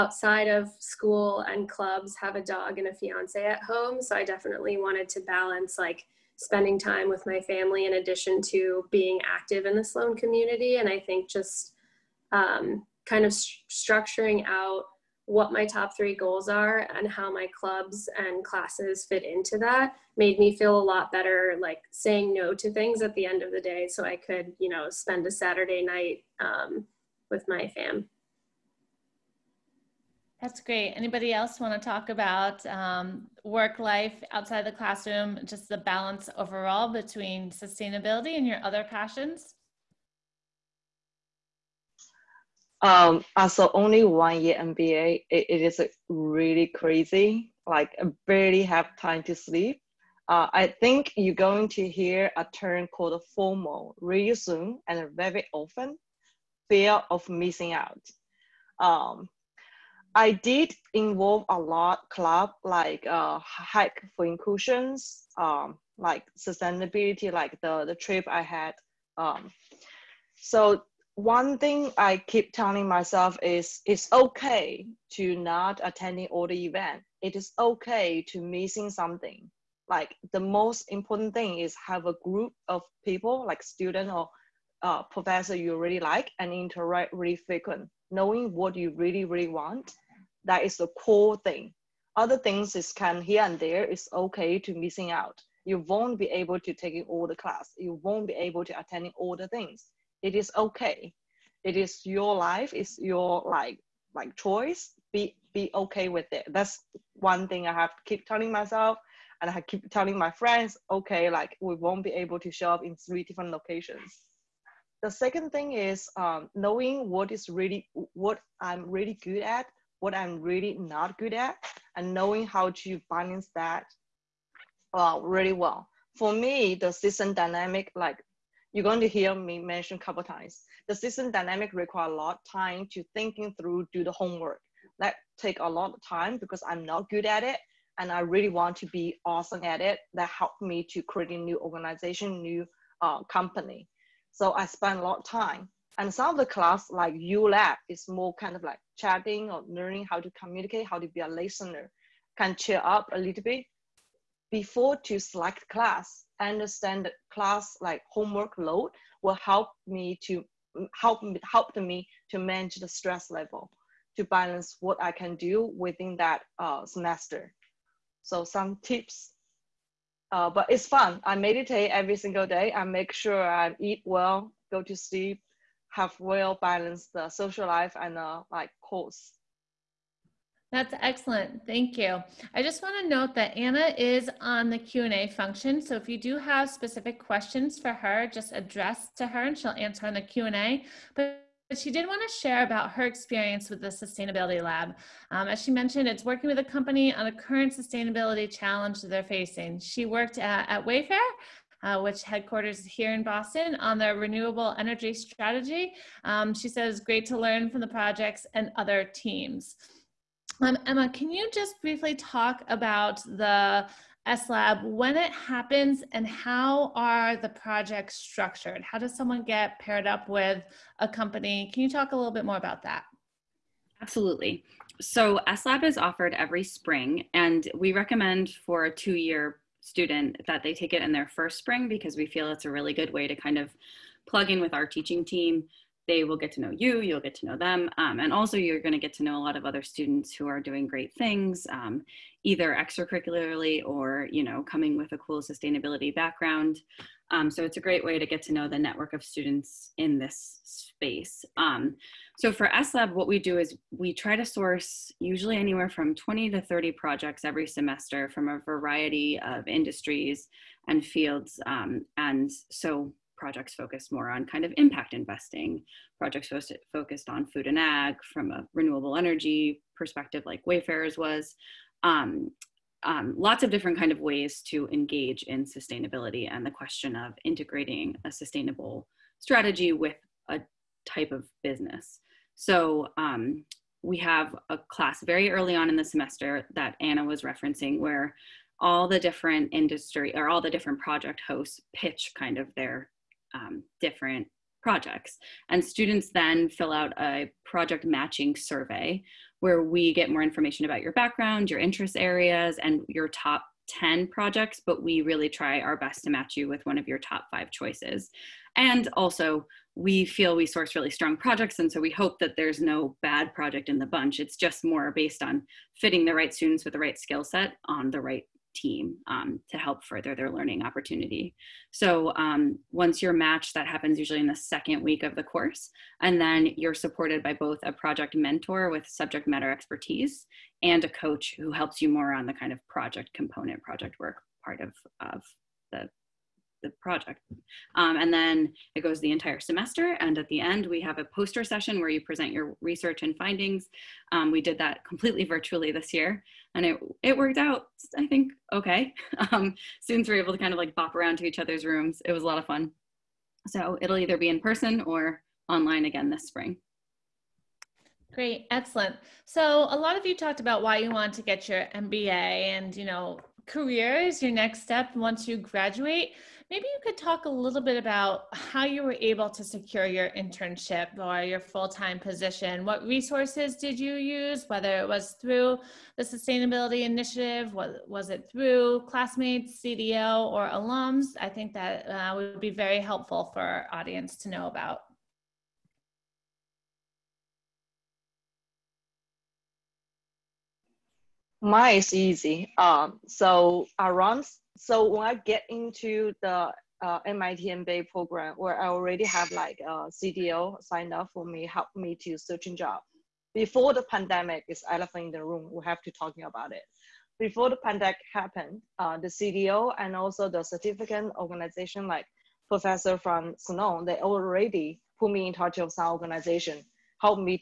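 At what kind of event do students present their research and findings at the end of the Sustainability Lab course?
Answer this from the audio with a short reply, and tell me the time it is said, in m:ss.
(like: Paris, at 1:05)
poster session, at 5:41.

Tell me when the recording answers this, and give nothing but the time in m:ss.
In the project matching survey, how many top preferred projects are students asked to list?
5:03.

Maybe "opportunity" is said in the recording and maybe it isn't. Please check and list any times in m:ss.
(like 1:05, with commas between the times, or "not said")
5:20.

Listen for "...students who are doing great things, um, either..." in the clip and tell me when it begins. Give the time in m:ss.
3:59.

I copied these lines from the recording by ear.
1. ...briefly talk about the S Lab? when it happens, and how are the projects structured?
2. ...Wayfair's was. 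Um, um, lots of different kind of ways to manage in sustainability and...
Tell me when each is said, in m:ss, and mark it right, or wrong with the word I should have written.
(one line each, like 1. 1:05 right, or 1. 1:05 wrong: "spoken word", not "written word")
1. 3:31 right
2. 4:30 wrong: "engage", not "manage".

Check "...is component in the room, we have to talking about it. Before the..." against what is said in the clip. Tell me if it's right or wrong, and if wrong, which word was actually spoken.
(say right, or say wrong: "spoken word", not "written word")
wrong: "elephant", not "component".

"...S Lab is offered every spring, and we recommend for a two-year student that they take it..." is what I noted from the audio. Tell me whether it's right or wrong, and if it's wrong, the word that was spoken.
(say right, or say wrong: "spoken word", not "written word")
right.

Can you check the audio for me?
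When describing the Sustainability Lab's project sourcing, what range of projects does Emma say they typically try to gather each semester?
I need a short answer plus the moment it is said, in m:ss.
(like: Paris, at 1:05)
20 to 30, at 4:16.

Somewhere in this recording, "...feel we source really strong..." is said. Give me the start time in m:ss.
5:10.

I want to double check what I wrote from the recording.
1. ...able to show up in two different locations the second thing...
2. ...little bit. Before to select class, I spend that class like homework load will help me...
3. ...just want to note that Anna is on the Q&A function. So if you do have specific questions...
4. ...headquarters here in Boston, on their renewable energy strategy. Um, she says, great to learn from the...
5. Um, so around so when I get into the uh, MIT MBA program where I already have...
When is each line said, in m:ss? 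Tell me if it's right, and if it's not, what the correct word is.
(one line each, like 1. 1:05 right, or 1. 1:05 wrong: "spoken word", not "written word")
1. 1:52 wrong: "three", not "two"
2. 2:33 wrong: "understand", not "spend"
3. 3:02 right
4. 3:22 right
5. 6:32 right.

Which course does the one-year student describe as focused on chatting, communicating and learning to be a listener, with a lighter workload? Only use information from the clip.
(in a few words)
ULab.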